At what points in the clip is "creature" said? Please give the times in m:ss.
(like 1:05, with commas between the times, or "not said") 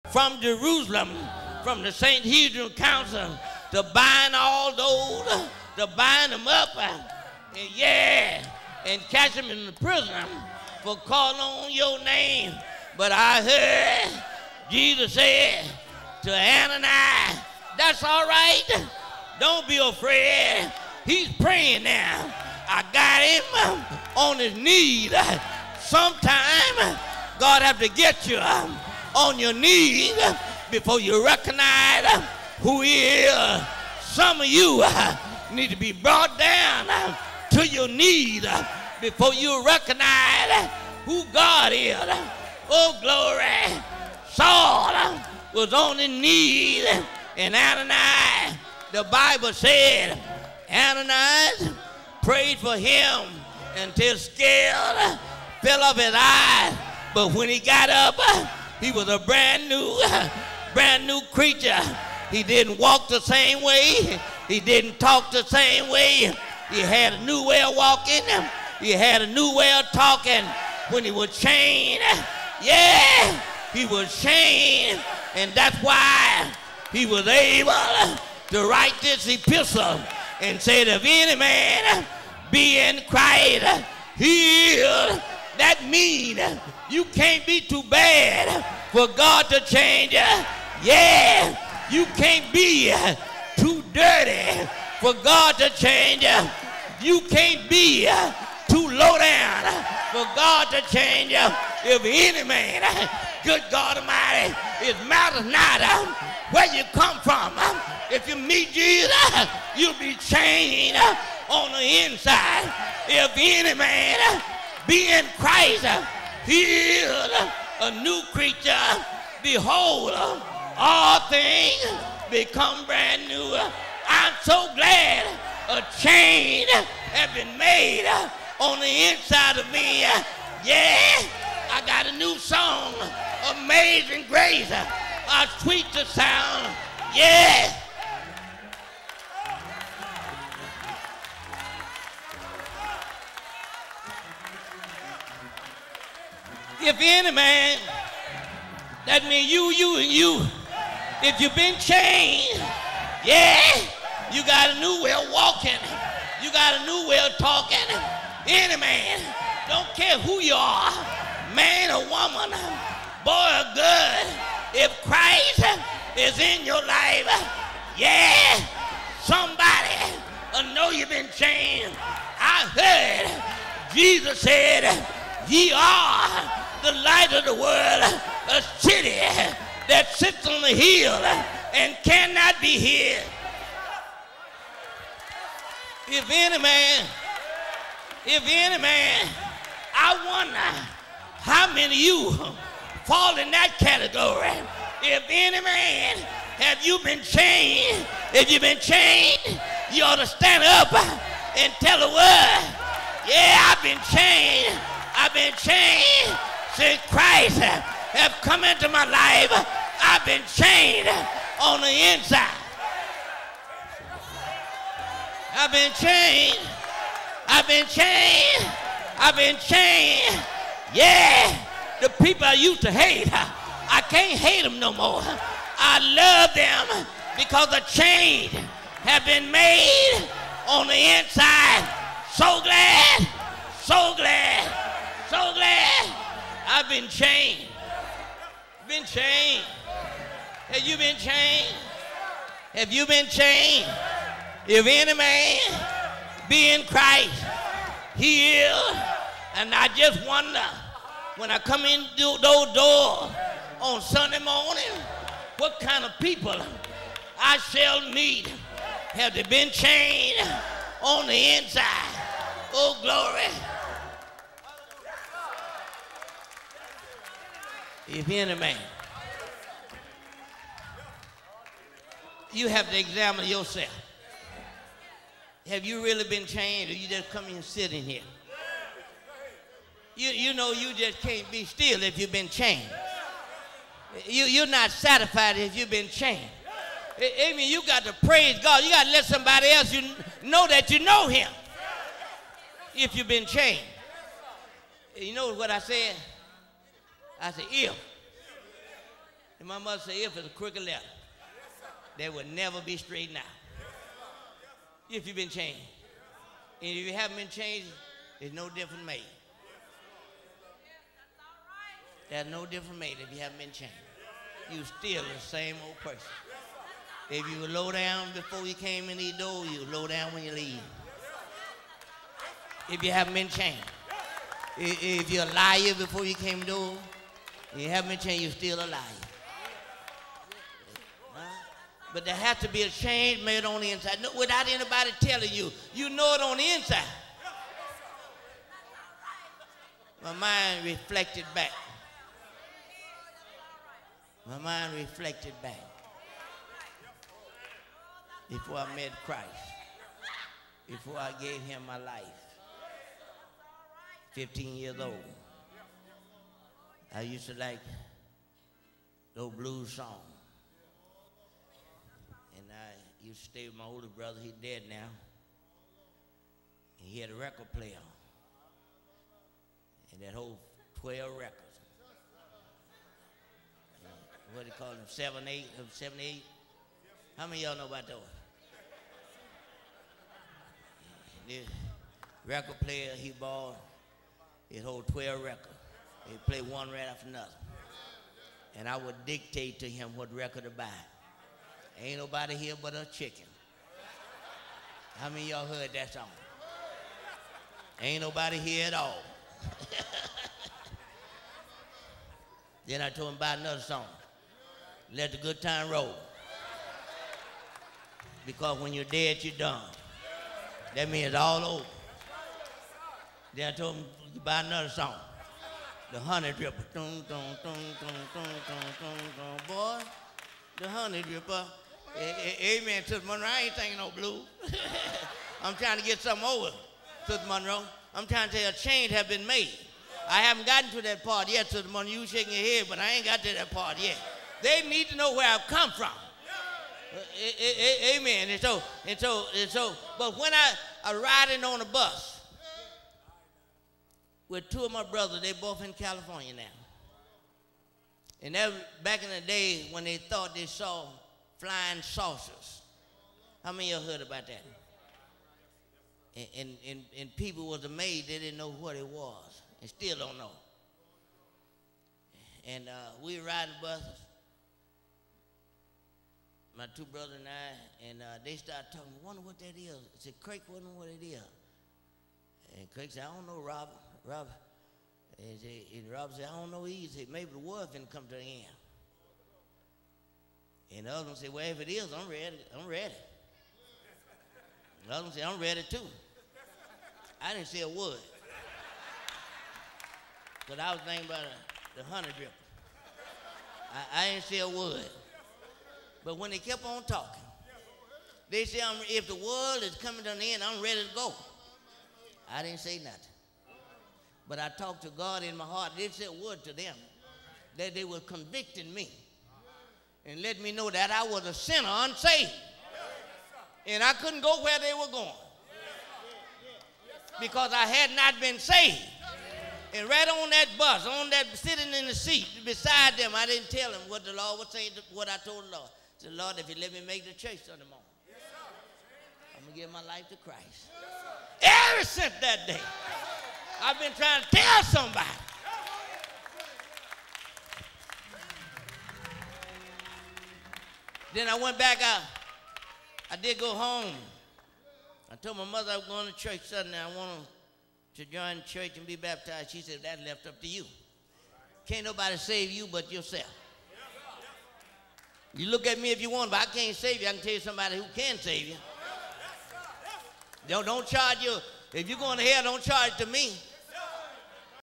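1:01, 1:58.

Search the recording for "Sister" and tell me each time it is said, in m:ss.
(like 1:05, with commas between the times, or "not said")
7:03, 7:07, 7:11.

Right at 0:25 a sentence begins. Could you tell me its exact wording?
Sometime God have to get you on your knees before you recognize who he is.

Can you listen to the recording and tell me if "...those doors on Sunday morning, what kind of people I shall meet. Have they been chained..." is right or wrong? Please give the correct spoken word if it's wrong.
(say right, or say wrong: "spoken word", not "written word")
right.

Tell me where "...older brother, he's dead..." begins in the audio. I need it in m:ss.
6:03.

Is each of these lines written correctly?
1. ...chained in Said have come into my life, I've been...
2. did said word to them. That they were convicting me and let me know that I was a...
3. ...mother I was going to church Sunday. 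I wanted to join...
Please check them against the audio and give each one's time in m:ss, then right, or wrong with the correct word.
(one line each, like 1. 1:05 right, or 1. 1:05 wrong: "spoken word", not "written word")
1. 3:25 wrong: "Christ", not "Said"
2. 8:25 right
3. 9:05 right.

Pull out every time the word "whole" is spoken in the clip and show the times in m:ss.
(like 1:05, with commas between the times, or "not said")
6:10, 6:24.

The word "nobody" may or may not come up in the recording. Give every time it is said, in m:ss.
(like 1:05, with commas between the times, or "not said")
6:32, 6:38, 9:12.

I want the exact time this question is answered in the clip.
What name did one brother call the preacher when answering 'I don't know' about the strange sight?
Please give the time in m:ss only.
7:53.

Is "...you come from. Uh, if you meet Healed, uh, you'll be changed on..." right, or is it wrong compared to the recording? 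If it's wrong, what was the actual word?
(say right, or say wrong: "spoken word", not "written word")
wrong: "Jesus", not "Healed".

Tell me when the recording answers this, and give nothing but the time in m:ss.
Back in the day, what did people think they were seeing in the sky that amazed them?
7:31.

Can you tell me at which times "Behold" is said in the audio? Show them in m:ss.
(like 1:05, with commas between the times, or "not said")
1:59.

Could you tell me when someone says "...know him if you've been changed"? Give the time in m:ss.
4:50.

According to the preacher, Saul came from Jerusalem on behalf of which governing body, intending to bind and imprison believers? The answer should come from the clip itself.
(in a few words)
Sanhedrin Council.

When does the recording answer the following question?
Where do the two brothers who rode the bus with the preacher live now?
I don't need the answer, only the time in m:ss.
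7:25.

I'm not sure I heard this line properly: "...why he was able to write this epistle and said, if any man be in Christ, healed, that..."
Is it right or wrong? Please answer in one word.
right.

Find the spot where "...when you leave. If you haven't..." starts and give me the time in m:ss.
5:20.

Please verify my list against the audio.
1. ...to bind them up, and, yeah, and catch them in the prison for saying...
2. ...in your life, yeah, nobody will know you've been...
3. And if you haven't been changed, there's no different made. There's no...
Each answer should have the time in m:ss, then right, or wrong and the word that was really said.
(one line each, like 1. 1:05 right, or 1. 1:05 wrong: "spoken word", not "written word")
1. 0:05 wrong: "calling", not "saying"
2. 2:46 wrong: "somebody", not "nobody"
3. 5:06 right.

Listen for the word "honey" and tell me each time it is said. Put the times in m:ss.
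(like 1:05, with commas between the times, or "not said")
6:56, 7:00, 8:12.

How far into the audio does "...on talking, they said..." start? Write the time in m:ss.
8:16.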